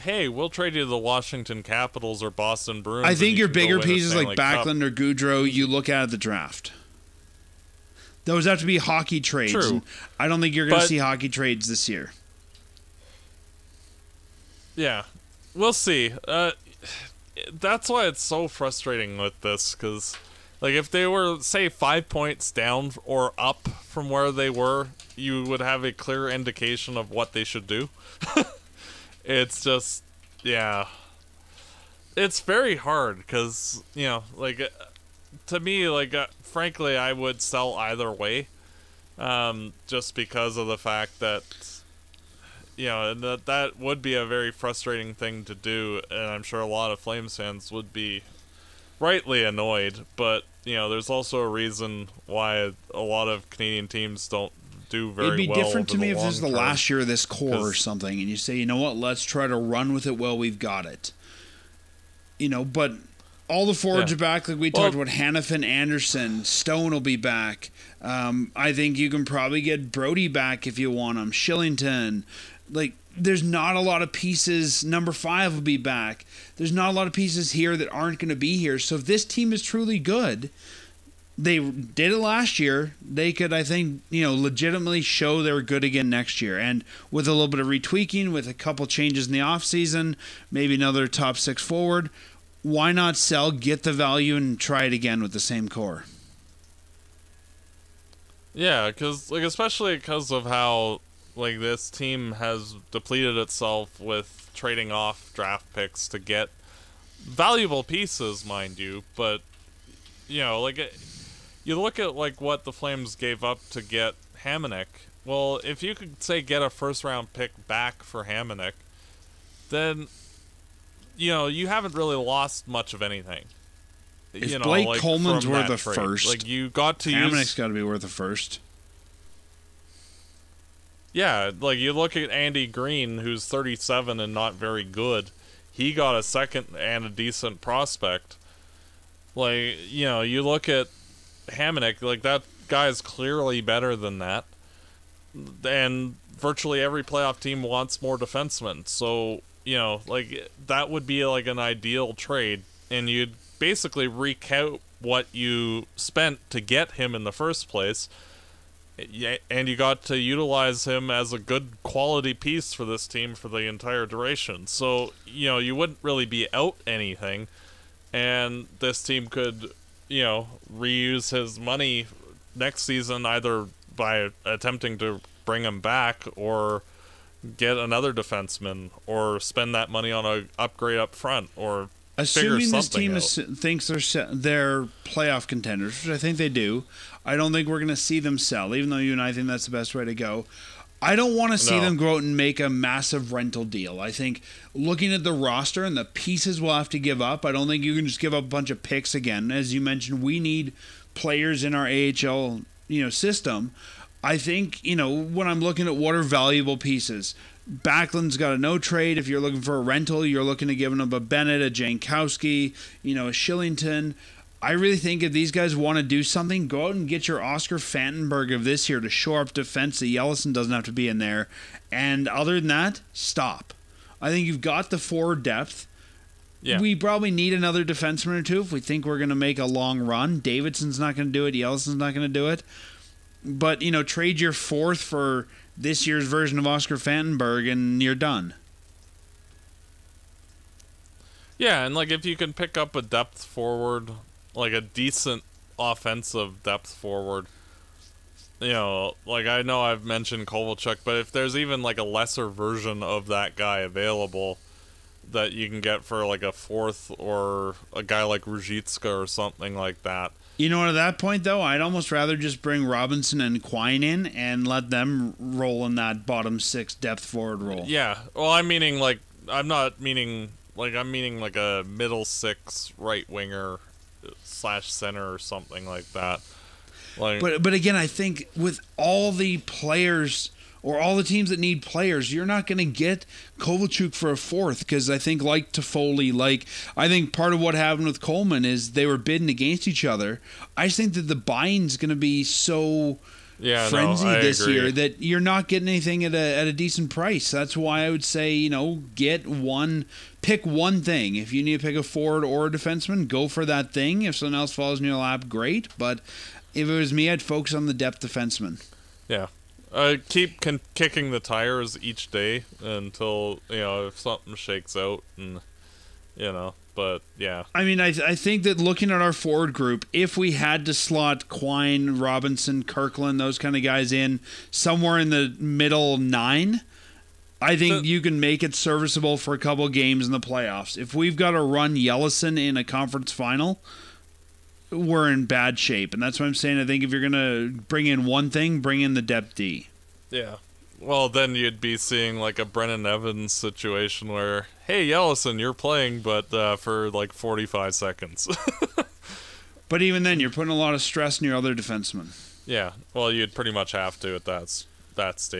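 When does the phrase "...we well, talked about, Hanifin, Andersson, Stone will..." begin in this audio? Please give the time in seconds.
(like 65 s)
64 s.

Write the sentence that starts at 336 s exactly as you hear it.
I think if you're gonna bring in one thing, bring in the depth D.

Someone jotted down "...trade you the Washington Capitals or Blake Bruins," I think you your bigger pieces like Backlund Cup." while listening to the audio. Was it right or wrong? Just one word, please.
wrong.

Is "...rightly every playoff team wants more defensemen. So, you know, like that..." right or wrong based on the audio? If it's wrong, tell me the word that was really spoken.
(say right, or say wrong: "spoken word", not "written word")
wrong: "virtually", not "rightly".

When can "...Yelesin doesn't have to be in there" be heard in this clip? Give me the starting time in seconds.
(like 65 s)
220 s.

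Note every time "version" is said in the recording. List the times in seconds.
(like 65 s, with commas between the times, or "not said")
236 s, 252 s.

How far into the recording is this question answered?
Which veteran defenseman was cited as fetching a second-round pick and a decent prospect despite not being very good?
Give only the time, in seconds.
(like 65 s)
132 s.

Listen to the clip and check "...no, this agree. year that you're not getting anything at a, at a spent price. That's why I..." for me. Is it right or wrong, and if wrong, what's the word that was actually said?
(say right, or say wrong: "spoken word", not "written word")
wrong: "decent", not "spent".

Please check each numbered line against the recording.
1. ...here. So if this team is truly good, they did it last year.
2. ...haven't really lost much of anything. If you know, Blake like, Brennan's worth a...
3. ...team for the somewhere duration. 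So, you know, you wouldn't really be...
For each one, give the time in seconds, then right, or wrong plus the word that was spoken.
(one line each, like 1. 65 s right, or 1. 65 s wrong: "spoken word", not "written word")
1. 78 s right
2. 121 s wrong: "Coleman", not "Brennan"
3. 163 s wrong: "entire", not "somewhere".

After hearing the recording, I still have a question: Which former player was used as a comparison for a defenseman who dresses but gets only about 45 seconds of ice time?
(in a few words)
Brennan Evans.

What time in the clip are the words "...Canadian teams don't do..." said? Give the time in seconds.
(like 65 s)
53 s.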